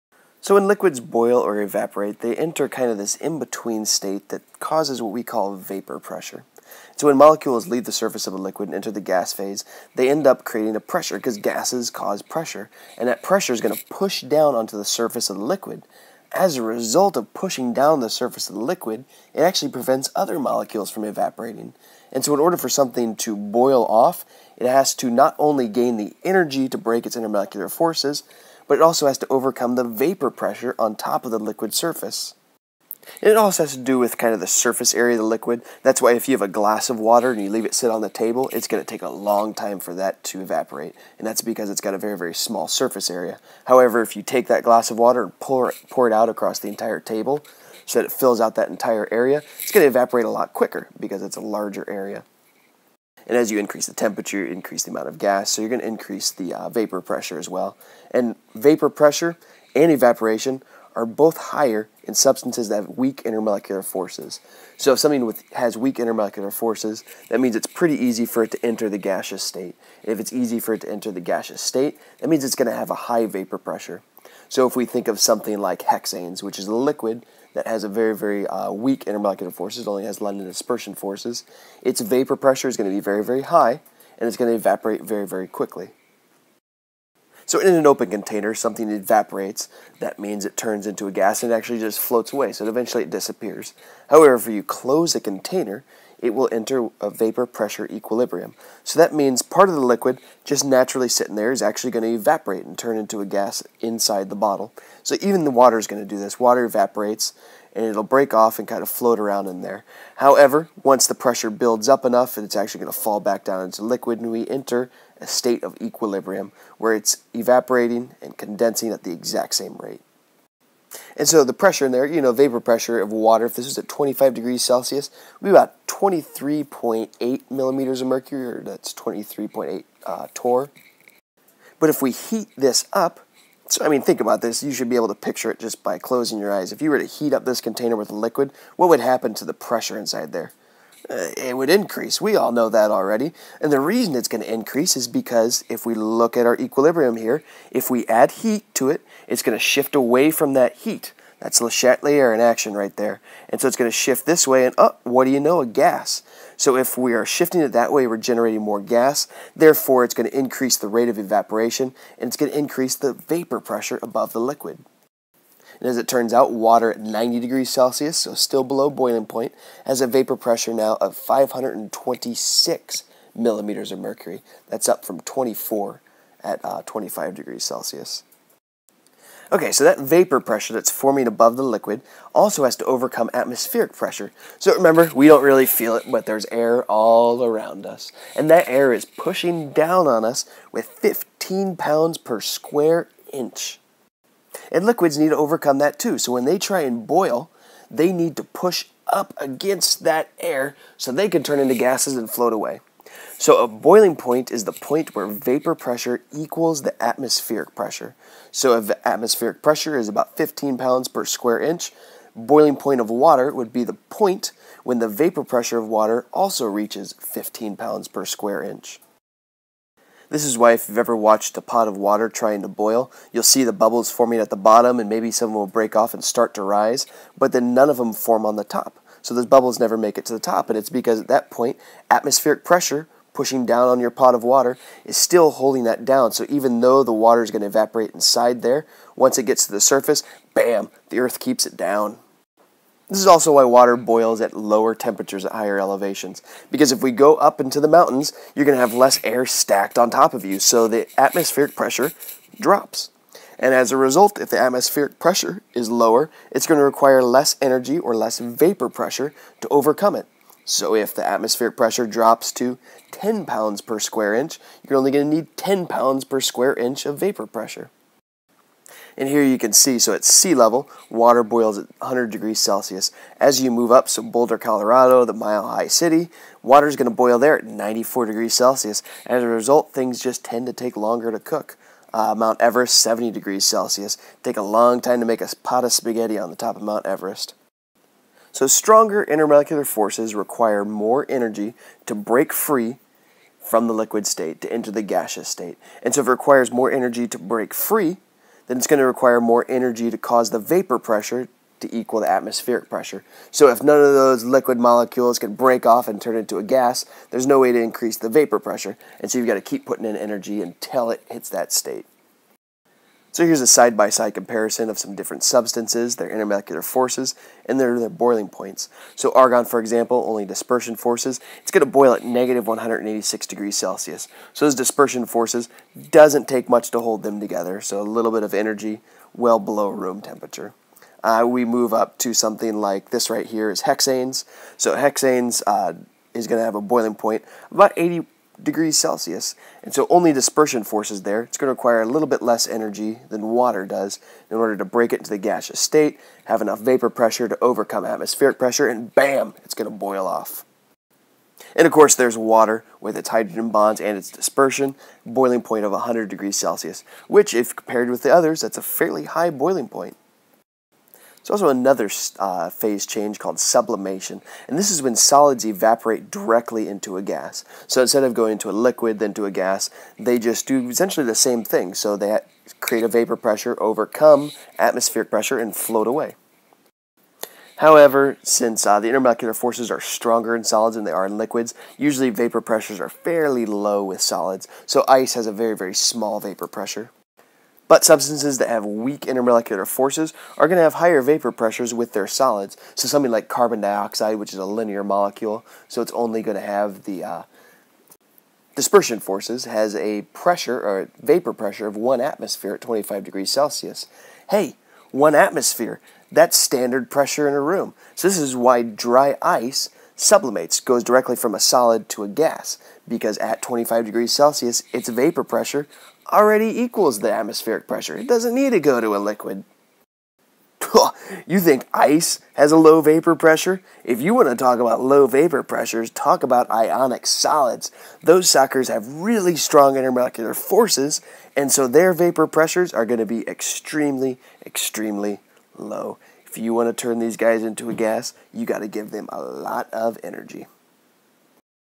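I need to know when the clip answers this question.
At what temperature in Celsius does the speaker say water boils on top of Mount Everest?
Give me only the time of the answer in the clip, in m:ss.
4:42.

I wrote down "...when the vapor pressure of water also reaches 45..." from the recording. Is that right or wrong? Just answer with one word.
wrong.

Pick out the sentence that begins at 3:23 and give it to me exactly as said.
So a boiling point is the point where vapor pressure equals the atmospheric pressure.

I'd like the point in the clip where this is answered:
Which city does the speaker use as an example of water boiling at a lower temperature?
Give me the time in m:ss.
4:34.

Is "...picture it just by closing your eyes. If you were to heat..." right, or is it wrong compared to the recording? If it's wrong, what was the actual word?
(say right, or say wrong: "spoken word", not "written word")
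right.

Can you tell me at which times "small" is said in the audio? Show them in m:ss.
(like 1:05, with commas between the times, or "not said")
0:42, 6:25.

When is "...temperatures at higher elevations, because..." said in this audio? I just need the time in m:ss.
4:04.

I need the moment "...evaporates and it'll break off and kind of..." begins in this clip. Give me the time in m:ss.
1:46.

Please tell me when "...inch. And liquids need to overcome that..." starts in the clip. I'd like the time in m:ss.
3:13.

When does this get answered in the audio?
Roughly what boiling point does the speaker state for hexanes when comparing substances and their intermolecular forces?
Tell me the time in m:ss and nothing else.
5:37.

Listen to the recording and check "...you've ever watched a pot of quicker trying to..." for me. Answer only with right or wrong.
wrong.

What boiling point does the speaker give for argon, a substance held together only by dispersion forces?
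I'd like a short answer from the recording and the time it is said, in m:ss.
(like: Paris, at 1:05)
-186 degrees Celsius, at 5:22.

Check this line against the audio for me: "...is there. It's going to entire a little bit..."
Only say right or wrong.
wrong.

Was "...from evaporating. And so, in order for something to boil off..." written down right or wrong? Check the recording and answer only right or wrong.
right.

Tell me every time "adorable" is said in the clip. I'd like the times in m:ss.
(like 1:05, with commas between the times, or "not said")
not said.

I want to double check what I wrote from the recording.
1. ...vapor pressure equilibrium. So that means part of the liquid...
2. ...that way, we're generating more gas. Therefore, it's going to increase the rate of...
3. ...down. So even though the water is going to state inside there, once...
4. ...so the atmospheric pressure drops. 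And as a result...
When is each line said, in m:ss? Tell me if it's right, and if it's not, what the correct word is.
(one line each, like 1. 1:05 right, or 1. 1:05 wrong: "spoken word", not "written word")
1. 1:37 right
2. 2:37 right
3. 3:56 wrong: "evaporate", not "state"
4. 4:10 right.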